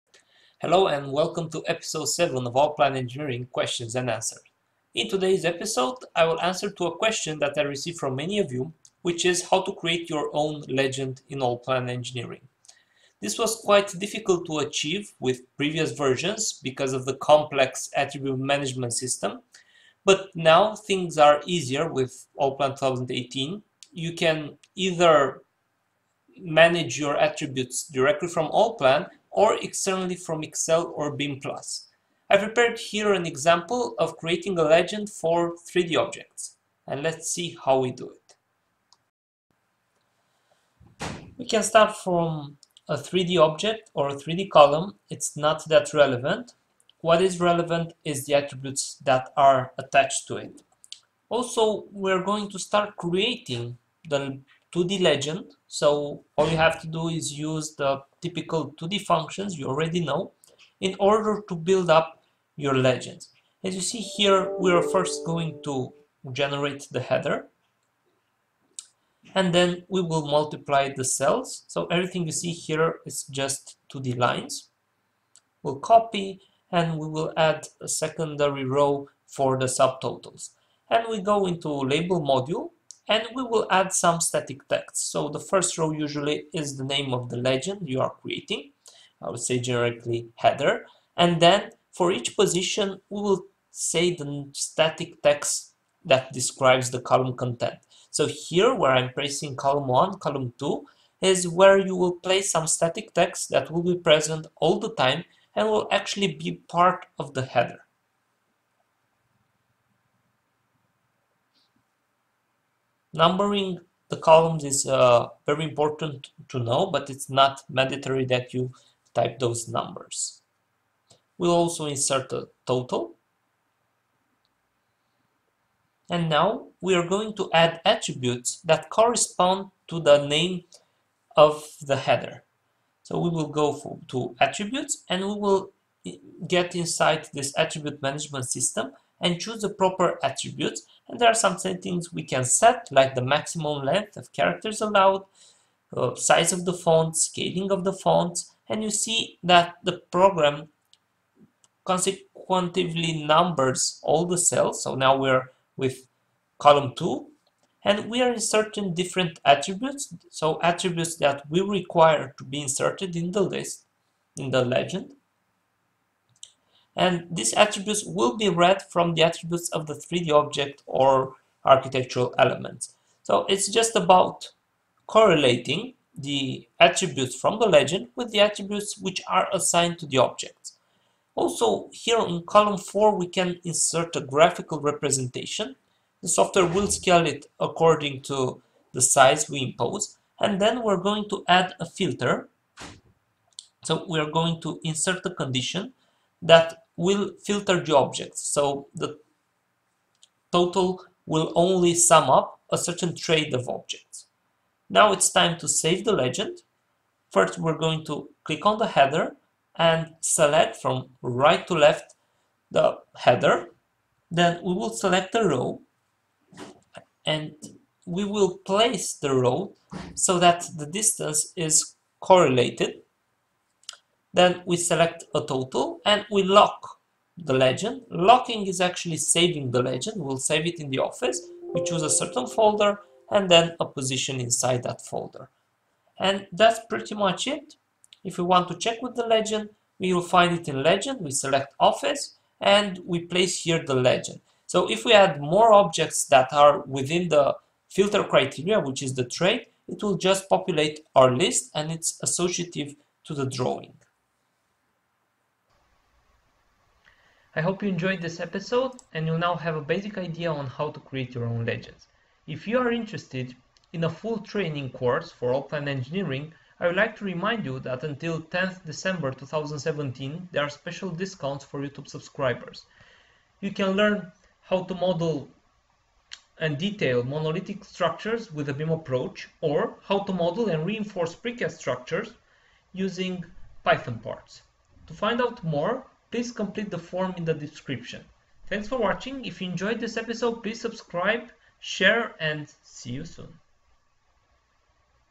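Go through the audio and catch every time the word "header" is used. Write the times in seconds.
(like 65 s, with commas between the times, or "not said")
67 s, 90 s, 107 s, 131 s, 208 s, 213 s.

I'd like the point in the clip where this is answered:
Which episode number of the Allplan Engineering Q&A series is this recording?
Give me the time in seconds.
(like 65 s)
1 s.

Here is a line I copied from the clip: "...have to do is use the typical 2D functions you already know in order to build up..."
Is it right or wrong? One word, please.
right.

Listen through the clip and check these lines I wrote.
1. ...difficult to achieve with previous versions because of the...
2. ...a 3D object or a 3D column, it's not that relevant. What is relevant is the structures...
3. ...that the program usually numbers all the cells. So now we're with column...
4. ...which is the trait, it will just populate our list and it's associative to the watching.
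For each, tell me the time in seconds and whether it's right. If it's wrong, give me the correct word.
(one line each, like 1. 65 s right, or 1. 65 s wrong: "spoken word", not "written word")
1. 13 s right
2. 42 s wrong: "attributes", not "structures"
3. 149 s wrong: "consequently", not "usually"
4. 248 s wrong: "drawing", not "watching".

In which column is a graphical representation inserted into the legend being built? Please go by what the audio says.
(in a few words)
Column 4.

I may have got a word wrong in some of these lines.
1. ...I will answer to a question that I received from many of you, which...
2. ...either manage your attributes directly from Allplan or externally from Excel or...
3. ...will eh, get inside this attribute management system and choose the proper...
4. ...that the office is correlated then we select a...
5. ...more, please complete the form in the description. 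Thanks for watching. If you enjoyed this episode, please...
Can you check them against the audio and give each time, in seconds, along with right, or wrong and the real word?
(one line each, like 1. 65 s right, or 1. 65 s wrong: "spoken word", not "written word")
1. 6 s right
2. 24 s right
3. 135 s right
4. 220 s wrong: "distance", not "office"
5. 285 s right.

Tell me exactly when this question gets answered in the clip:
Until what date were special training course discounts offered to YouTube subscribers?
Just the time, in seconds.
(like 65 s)
268 s.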